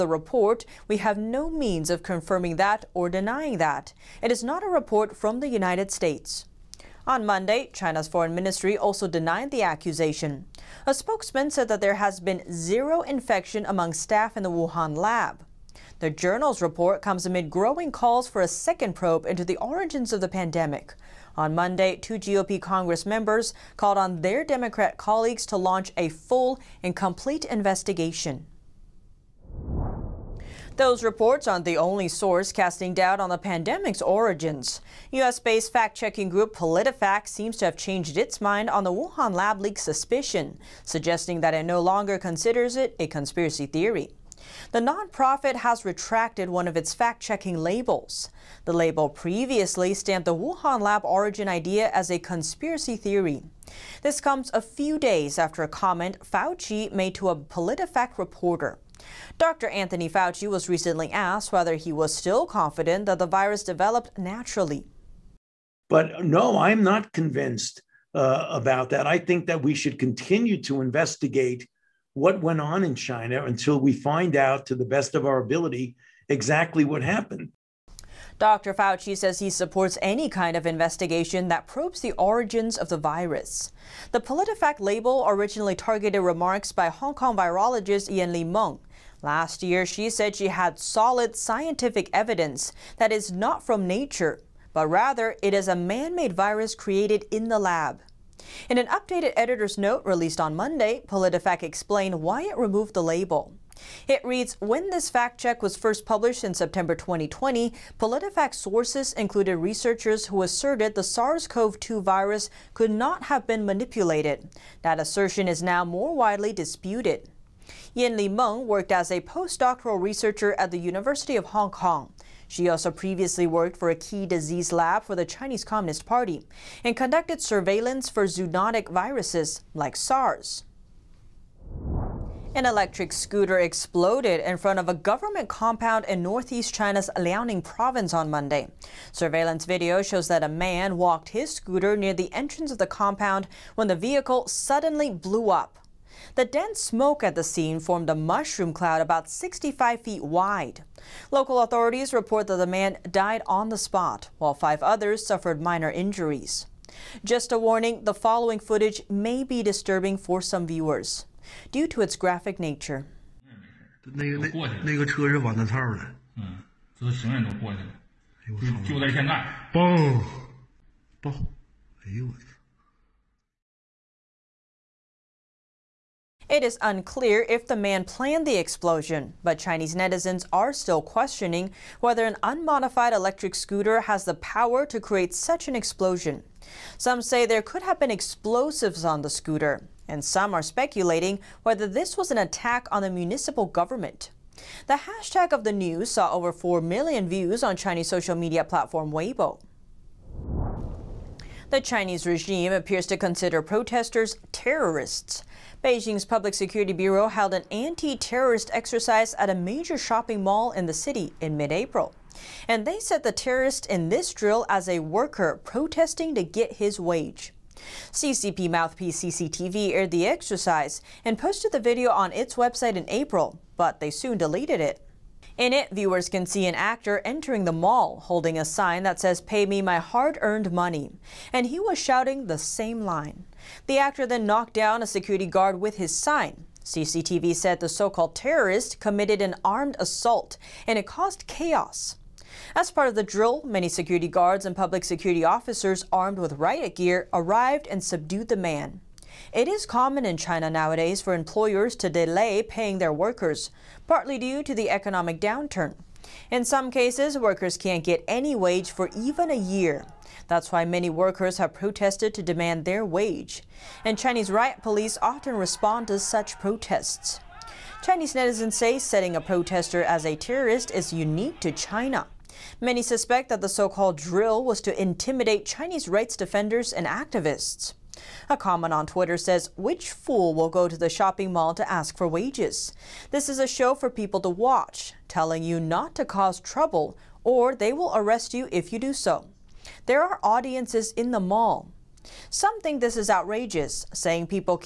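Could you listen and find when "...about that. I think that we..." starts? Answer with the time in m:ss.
1:08.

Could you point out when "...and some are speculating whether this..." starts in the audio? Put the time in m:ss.
3:10.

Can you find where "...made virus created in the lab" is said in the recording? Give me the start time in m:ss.
1:36.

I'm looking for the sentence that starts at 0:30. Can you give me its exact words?
Those reports aren't the only source casting doubt on the pandemic's origins.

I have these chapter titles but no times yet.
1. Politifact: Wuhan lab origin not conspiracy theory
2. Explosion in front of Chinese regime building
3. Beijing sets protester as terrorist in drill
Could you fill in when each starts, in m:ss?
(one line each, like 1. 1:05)
1. 0:30
2. 2:12
3. 3:21.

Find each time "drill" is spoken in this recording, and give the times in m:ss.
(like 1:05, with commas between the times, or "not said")
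3:34, 4:03, 4:34.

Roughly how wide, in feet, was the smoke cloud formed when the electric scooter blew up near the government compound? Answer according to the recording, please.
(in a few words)
65 feet.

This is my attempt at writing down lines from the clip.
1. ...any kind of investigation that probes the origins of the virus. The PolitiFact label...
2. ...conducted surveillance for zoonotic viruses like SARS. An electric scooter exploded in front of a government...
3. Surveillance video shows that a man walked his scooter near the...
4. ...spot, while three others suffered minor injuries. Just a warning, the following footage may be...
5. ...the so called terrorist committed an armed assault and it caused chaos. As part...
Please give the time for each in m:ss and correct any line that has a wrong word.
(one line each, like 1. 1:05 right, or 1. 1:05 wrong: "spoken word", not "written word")
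1. 1:20 right
2. 2:06 right
3. 2:19 right
4. 2:33 wrong: "five", not "three"
5. 3:57 right.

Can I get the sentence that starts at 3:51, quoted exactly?
And he was shouting the same line.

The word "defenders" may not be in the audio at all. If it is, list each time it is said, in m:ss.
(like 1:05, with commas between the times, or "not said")
4:36.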